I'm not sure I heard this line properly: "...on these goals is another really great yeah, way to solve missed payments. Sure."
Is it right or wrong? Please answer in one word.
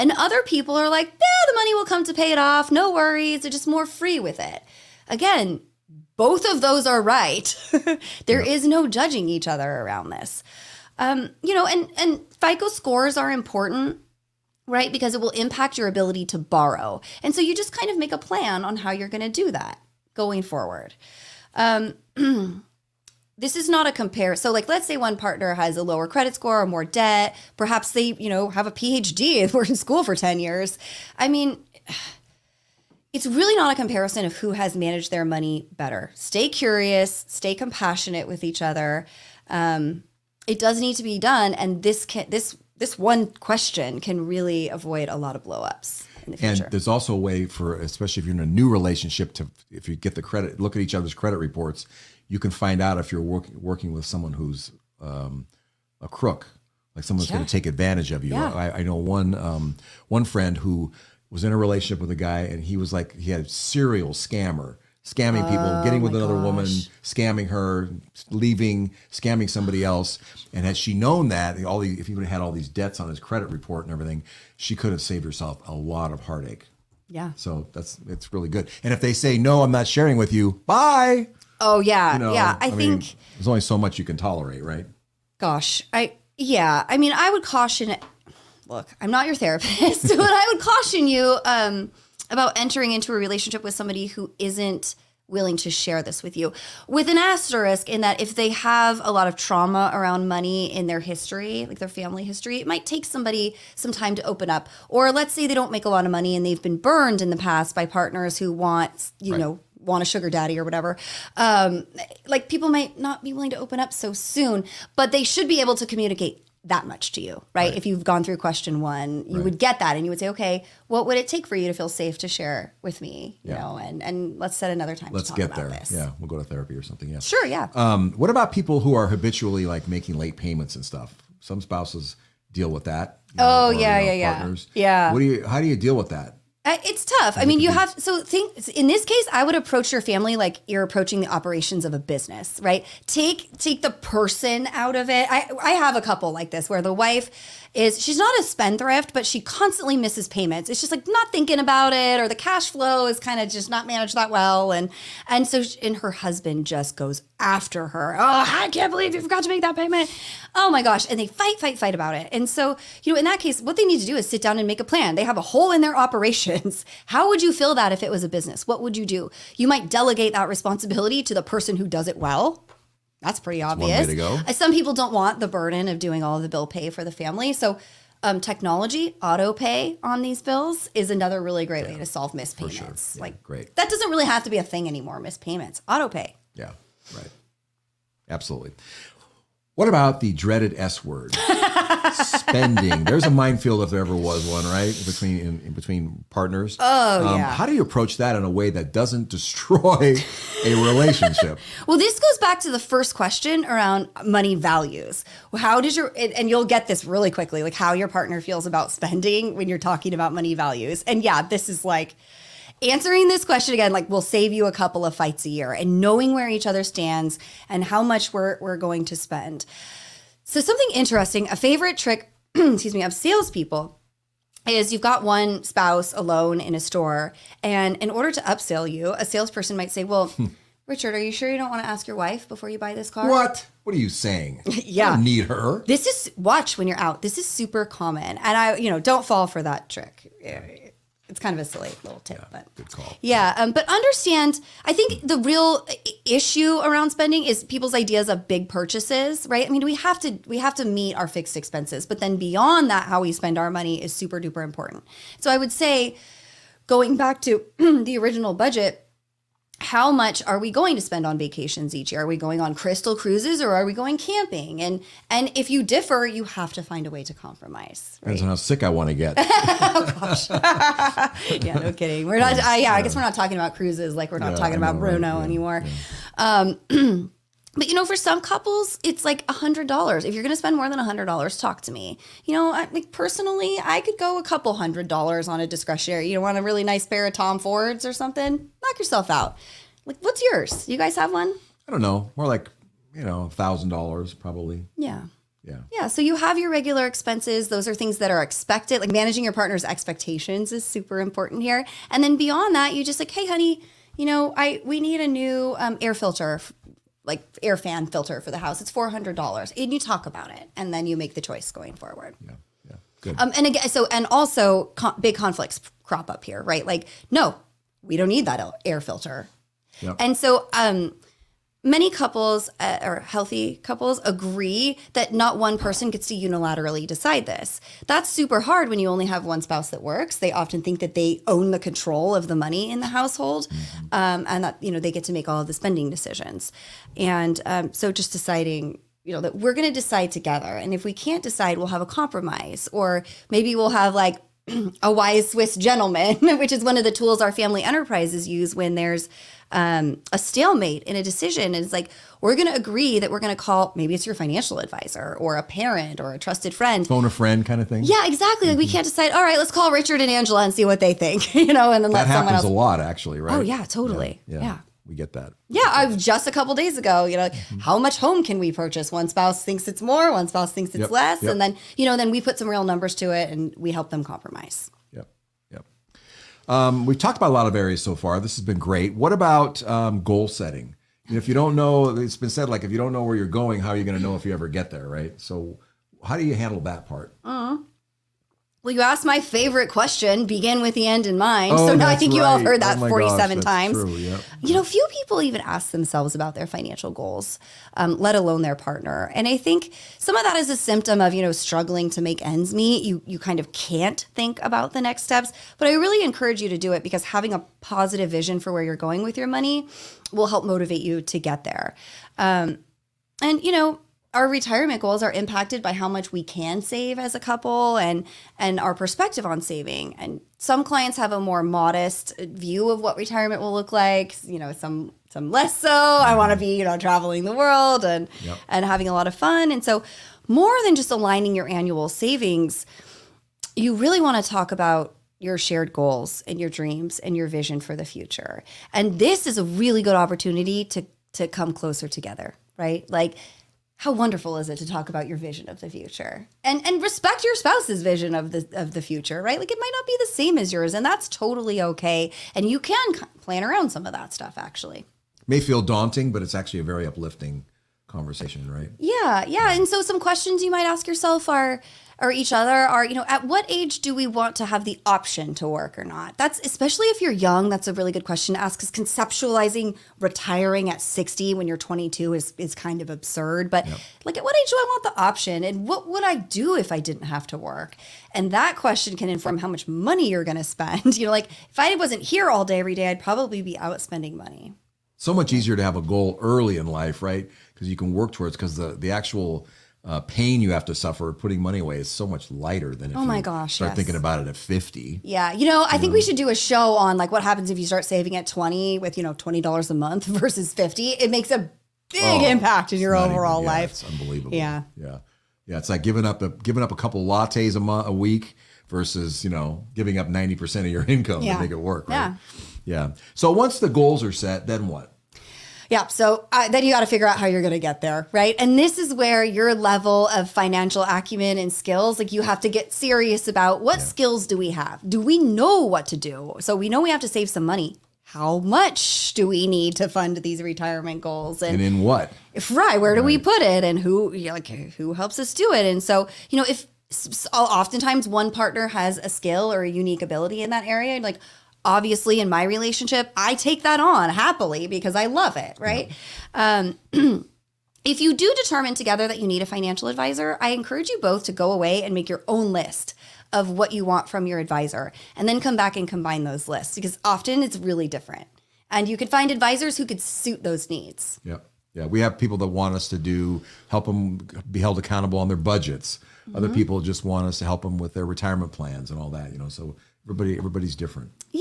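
wrong.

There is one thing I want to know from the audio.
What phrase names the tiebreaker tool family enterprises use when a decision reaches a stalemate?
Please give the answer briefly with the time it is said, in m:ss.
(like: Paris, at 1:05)
wise Swiss gentleman, at 5:45.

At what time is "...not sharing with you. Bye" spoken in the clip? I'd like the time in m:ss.
1:19.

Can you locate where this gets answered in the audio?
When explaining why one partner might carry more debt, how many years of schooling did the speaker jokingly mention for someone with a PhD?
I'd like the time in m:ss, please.
0:30.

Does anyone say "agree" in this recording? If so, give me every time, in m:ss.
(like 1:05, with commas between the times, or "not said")
5:24, 5:52.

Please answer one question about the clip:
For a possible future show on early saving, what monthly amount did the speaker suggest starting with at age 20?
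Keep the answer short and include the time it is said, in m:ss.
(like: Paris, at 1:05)
$20, at 8:19.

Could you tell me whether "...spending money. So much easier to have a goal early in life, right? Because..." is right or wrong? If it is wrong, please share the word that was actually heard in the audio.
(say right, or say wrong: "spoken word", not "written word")
right.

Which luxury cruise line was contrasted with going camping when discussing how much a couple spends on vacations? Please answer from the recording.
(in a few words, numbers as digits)
Crystal Cruises.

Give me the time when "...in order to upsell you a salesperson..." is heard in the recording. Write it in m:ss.
3:47.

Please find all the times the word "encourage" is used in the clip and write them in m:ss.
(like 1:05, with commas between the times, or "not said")
6:46, 9:10.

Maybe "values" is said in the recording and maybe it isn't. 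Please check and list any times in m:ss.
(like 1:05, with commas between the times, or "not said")
3:24, 3:30.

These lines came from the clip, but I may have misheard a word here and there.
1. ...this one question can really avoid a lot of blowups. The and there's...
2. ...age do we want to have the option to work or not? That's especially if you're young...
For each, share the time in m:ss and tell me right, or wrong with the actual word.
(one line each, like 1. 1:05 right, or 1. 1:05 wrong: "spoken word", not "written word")
1. 0:42 right
2. 7:43 right.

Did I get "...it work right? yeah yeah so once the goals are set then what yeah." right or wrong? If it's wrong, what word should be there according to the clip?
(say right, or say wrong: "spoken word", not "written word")
right.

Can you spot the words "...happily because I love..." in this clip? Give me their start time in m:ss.
9:04.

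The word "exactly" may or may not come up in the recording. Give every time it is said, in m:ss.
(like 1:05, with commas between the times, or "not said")
5:58.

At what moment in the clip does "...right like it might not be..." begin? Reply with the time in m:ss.
7:29.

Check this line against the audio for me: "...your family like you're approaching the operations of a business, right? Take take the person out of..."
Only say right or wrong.
right.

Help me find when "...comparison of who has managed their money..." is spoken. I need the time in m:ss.
0:33.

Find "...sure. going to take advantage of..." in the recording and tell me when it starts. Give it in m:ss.
0:57.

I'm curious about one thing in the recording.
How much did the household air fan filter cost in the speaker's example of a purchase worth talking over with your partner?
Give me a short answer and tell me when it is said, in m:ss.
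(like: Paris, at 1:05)
$400, at 5:08.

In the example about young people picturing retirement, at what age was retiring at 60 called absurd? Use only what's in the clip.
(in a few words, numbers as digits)
22.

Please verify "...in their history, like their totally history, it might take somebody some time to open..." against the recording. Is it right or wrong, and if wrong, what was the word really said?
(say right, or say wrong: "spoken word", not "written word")
wrong: "family", not "totally".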